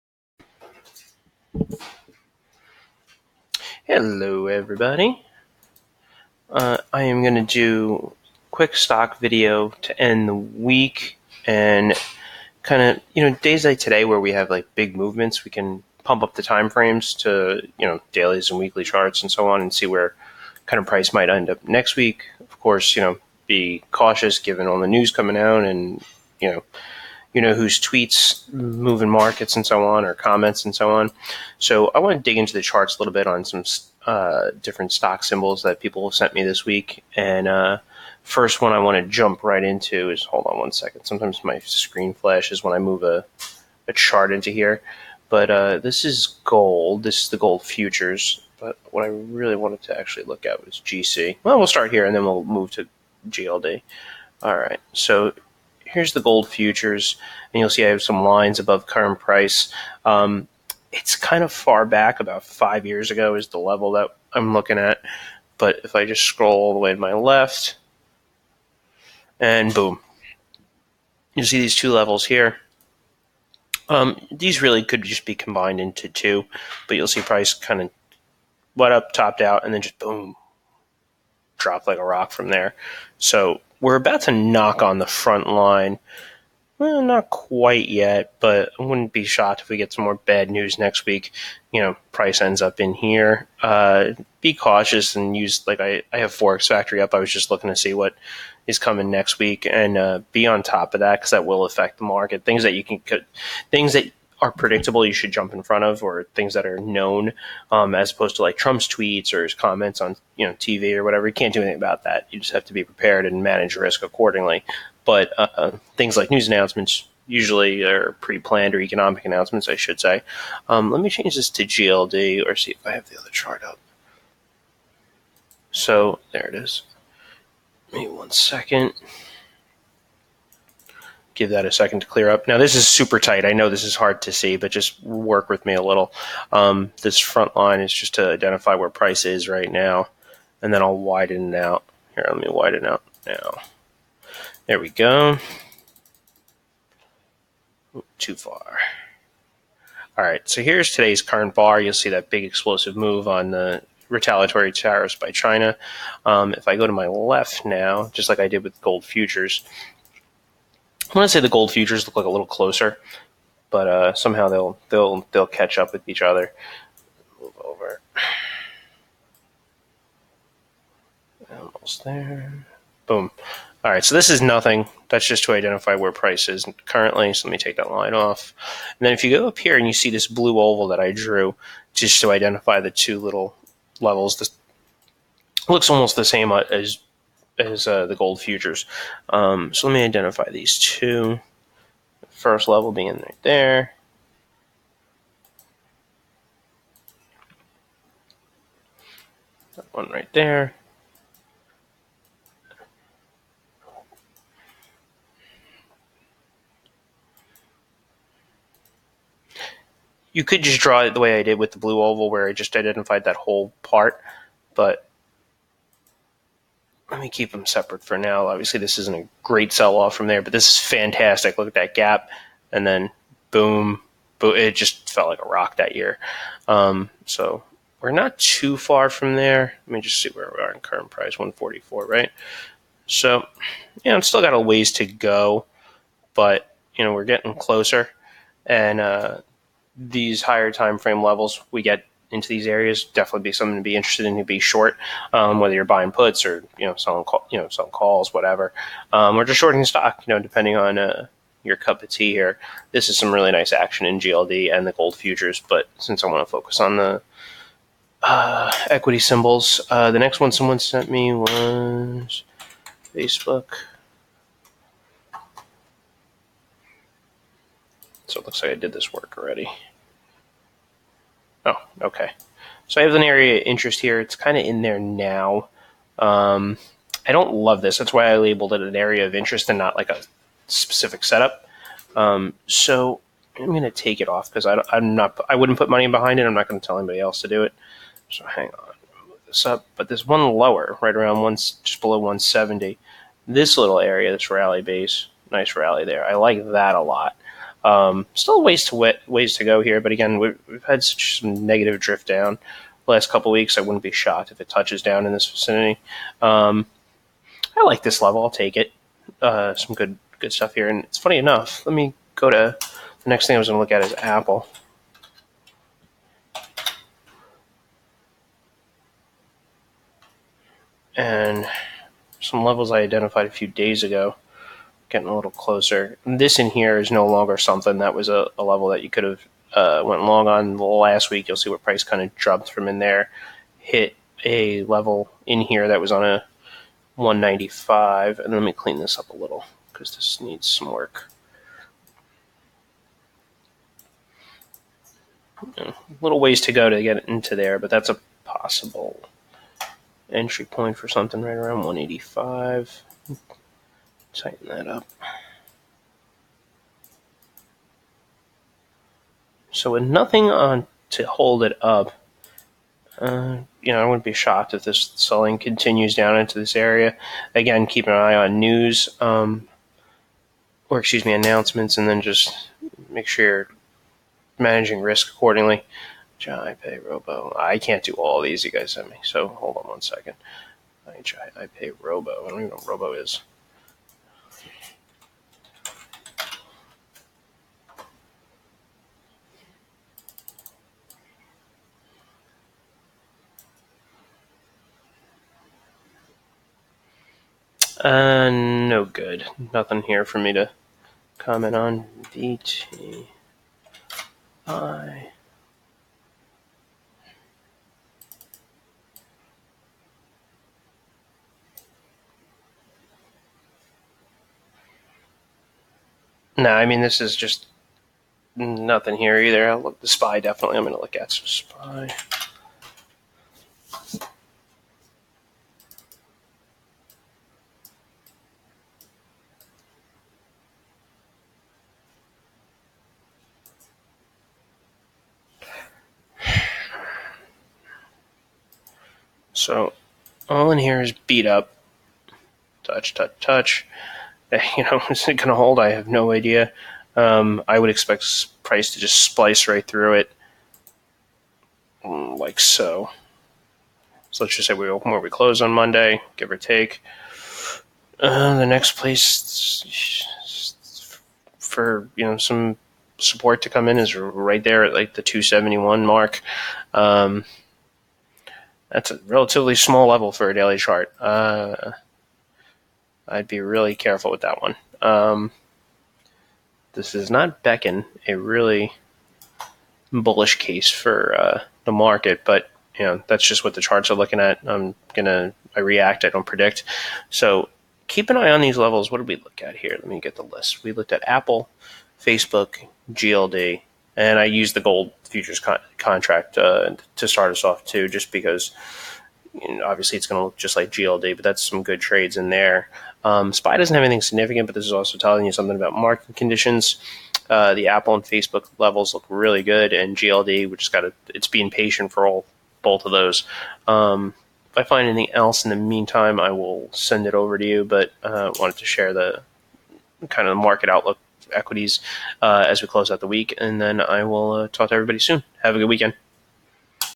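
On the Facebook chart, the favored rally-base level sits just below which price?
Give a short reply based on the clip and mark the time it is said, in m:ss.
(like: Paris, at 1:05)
170, at 4:51.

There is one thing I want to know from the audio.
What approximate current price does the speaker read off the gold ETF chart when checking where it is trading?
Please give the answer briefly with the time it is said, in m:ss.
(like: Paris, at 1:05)
144, at 3:51.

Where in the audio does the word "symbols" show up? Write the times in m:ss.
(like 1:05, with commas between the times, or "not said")
0:35, 4:19.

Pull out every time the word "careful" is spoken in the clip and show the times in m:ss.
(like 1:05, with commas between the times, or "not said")
7:53.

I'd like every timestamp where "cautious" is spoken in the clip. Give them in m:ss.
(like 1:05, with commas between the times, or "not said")
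0:23, 1:34.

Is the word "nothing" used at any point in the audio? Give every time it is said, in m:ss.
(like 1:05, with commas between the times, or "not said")
2:54, 6:00, 6:39, 6:58.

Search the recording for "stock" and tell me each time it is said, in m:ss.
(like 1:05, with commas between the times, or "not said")
0:08, 0:34, 4:09.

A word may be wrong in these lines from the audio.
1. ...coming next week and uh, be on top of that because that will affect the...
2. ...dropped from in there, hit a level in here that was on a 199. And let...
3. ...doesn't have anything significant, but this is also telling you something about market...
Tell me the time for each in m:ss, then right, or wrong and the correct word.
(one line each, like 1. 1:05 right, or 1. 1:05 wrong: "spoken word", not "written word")
1. 1:38 right
2. 5:32 wrong: "195", not "199"
3. 8:23 right.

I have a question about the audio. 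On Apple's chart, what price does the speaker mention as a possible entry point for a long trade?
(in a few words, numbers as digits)
185.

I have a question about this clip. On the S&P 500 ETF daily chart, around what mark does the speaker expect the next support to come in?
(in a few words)
271.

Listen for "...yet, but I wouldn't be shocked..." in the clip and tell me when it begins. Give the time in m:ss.
1:27.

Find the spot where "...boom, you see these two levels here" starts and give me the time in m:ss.
1:09.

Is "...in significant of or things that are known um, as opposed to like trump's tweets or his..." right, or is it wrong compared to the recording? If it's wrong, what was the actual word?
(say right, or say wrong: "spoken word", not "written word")
wrong: "front", not "significant".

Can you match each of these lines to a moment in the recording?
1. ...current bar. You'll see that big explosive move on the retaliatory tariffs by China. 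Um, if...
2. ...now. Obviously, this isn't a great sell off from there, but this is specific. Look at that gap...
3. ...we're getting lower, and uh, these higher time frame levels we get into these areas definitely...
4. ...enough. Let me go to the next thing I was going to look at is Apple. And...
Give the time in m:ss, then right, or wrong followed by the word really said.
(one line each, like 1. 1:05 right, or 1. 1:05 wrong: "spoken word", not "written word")
1. 2:31 right
2. 3:38 wrong: "fantastic", not "specific"
3. 3:57 wrong: "closer", not "lower"
4. 5:11 right.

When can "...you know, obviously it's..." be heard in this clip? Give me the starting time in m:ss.
8:19.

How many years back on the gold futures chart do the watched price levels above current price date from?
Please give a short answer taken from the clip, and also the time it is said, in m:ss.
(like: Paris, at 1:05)
5 years, at 1:02.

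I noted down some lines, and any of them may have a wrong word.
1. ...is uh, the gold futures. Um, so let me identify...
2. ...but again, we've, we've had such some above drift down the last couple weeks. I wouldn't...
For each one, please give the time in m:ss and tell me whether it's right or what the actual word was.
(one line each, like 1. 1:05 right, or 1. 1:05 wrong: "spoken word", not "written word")
1. 3:07 right
2. 5:00 wrong: "negative", not "above".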